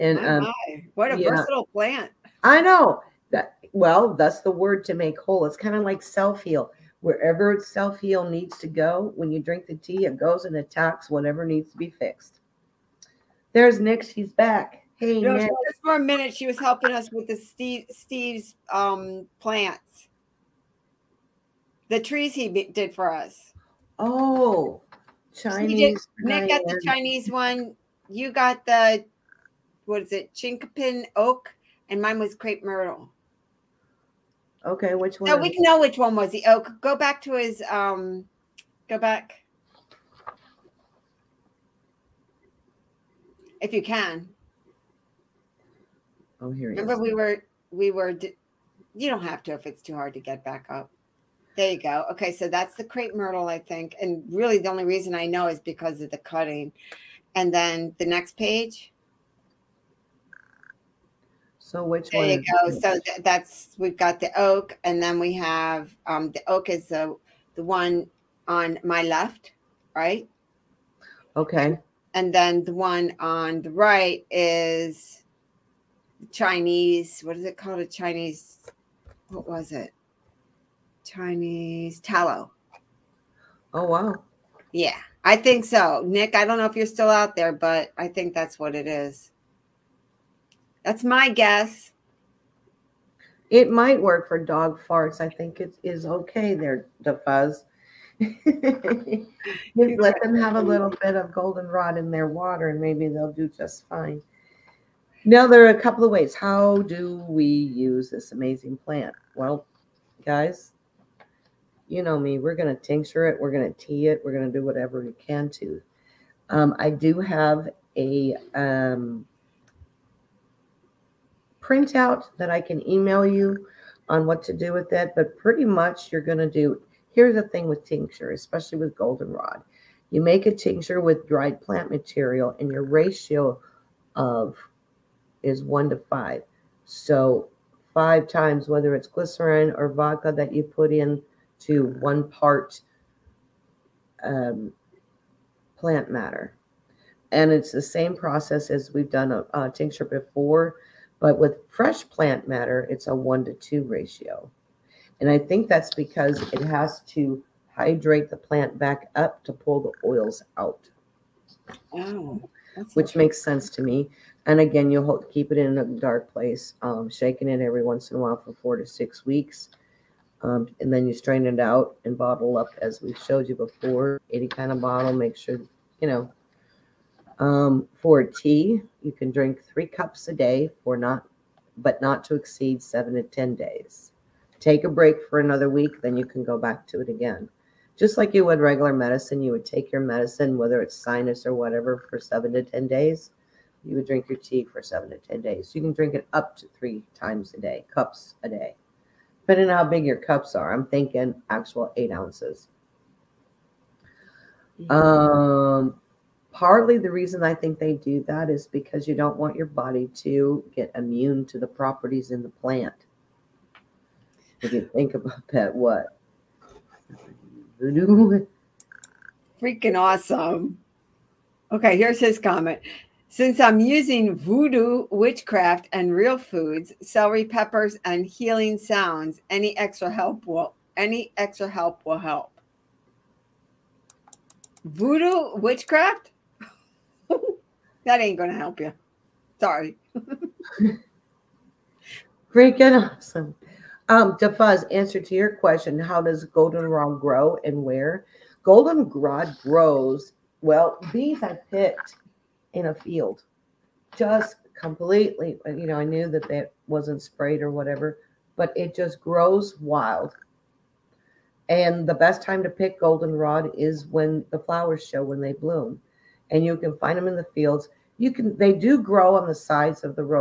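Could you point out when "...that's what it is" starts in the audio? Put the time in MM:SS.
01:28.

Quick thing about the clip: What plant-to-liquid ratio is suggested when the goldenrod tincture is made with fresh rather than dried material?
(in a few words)
1 to 2.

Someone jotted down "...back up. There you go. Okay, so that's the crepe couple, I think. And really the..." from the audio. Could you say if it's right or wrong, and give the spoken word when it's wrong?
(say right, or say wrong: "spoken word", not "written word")
wrong: "myrtle", not "couple".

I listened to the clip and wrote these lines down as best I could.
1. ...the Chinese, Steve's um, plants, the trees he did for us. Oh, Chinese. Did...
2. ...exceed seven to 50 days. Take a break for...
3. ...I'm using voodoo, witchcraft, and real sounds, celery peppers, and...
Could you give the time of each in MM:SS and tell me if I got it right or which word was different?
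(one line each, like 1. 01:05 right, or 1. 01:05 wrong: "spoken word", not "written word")
1. 00:17 wrong: "Steve", not "Chinese"
2. 03:02 wrong: "10", not "50"
3. 03:43 wrong: "foods", not "sounds".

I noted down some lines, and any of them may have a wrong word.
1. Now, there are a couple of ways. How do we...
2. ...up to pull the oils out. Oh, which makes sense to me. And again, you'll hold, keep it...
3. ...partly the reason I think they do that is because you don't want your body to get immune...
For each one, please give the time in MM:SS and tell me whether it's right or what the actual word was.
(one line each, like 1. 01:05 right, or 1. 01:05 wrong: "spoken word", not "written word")
1. 01:45 right
2. 02:39 right
3. 03:26 right.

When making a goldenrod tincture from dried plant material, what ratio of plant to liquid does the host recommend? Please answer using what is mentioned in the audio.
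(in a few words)
1 to 5.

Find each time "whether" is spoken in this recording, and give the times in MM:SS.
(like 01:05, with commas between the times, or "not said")
02:18, 03:10.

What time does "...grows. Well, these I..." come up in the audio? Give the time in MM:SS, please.
04:09.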